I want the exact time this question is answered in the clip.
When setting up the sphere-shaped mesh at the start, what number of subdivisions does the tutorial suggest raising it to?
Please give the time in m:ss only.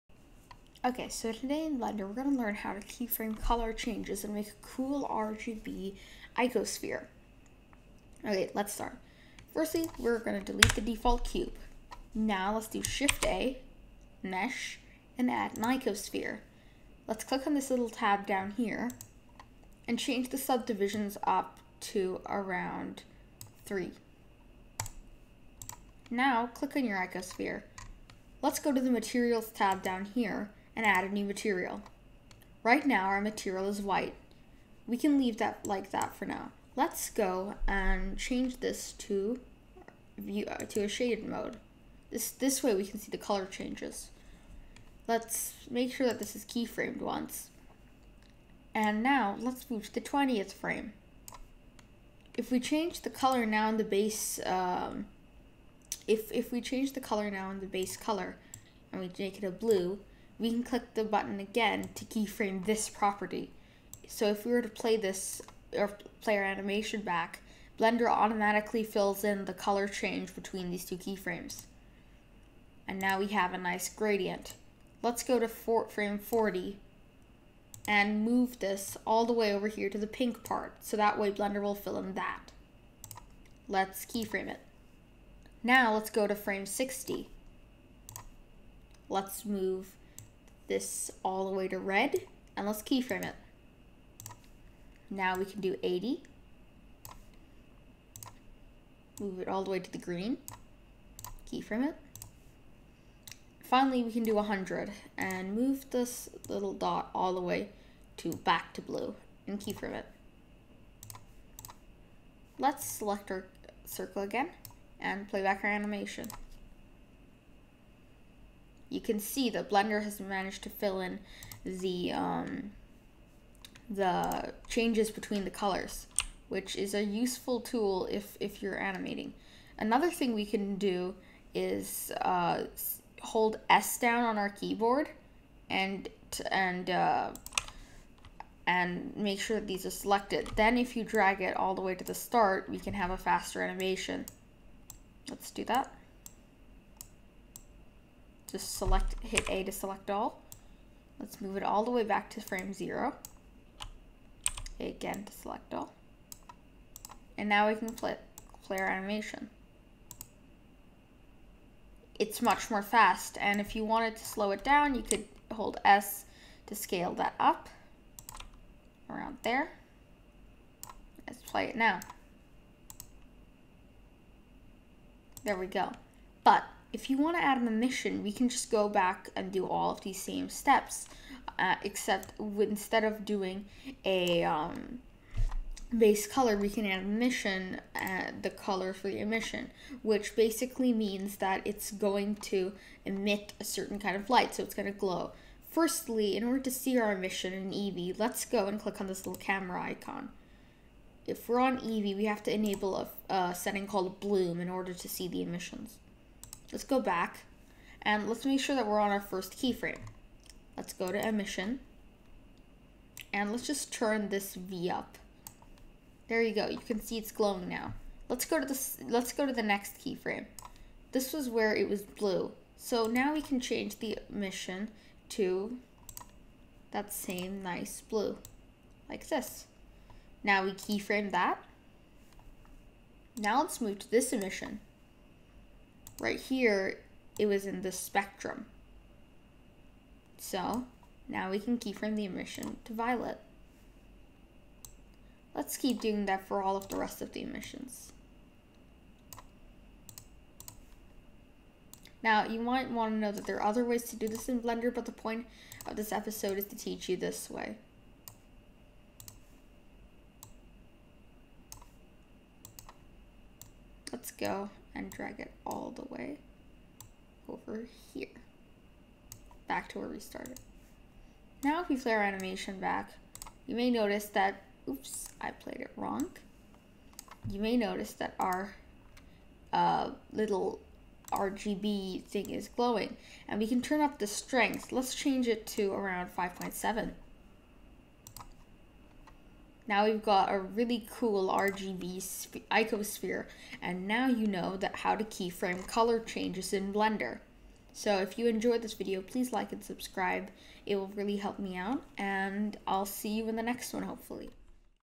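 0:22.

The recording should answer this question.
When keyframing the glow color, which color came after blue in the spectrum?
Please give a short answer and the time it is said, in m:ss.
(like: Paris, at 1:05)
violet, at 4:02.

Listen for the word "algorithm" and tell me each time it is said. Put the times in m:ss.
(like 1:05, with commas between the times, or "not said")
not said.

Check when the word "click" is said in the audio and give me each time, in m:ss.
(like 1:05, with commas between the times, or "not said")
0:17, 0:26, 1:00, 3:18.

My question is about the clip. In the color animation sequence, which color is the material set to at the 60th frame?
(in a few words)
red.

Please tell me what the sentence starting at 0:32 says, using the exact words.
Right now our material is white.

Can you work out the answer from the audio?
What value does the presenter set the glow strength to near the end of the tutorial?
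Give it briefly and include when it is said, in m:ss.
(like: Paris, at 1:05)
5.7, at 4:46.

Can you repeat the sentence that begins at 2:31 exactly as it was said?
Let's move it all the way back to frame zero.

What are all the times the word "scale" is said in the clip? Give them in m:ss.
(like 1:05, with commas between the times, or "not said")
2:46.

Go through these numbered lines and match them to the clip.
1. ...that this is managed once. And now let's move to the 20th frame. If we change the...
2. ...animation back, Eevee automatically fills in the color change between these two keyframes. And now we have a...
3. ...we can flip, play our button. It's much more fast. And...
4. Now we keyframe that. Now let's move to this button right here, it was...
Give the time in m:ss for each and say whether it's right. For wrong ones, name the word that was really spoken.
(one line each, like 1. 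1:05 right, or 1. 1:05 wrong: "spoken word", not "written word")
1. 0:46 wrong: "keyframed", not "managed"
2. 1:06 wrong: "Blender", not "Eevee"
3. 2:37 wrong: "animation", not "button"
4. 3:50 wrong: "emission", not "button".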